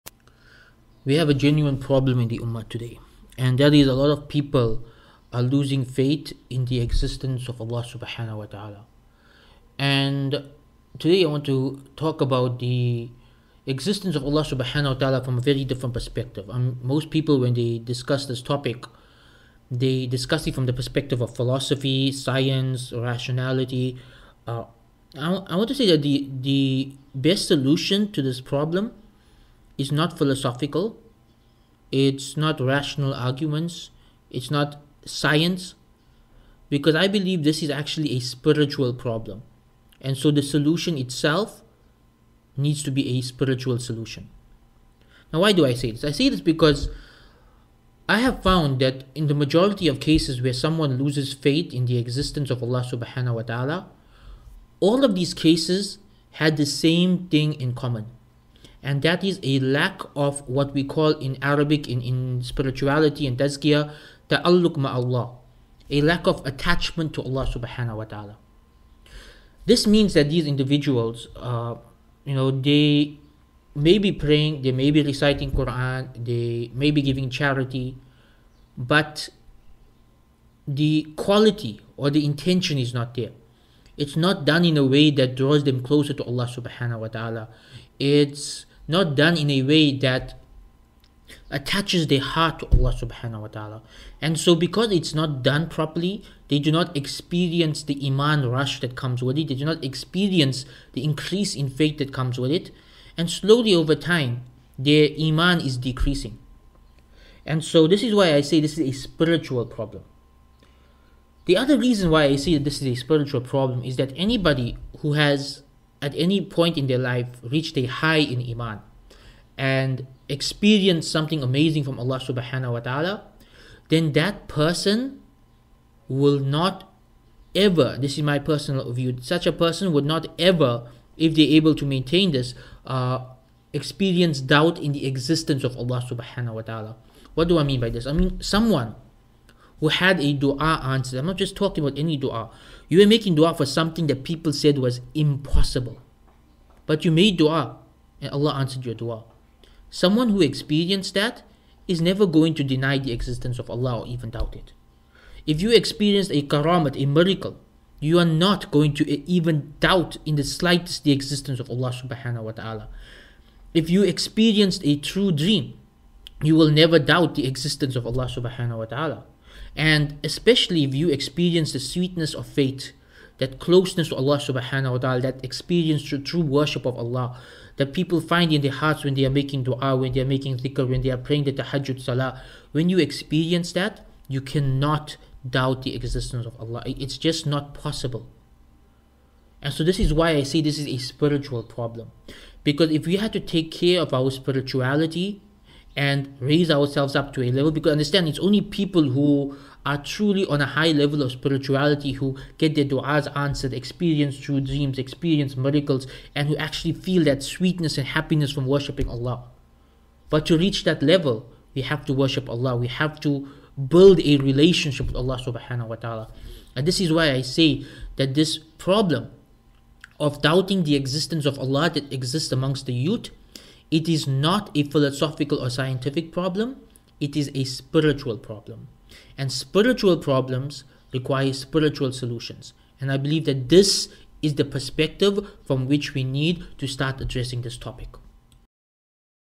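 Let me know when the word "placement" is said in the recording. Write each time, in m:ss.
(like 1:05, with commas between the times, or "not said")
not said.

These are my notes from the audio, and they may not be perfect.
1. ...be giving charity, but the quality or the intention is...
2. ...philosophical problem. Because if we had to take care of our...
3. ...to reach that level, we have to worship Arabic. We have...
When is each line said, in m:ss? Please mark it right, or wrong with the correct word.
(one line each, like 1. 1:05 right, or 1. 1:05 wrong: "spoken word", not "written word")
1. 1:16 right
2. 3:10 wrong: "spiritual", not "philosophical"
3. 3:30 wrong: "Allah", not "Arabic".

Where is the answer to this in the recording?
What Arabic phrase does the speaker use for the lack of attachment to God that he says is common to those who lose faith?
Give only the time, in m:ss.
1:04.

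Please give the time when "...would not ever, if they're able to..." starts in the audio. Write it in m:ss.
2:09.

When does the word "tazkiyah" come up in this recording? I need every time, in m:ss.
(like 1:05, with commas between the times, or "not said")
1:03.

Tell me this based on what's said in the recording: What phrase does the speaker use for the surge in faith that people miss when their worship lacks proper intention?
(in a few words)
iman rush.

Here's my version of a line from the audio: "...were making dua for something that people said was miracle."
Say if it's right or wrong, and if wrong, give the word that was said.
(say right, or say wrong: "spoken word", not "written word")
wrong: "impossible", not "miracle".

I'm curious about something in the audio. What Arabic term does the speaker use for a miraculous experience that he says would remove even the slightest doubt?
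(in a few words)
karamat.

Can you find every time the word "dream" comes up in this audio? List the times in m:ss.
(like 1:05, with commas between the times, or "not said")
2:45, 3:24.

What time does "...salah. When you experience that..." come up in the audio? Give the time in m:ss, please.
3:02.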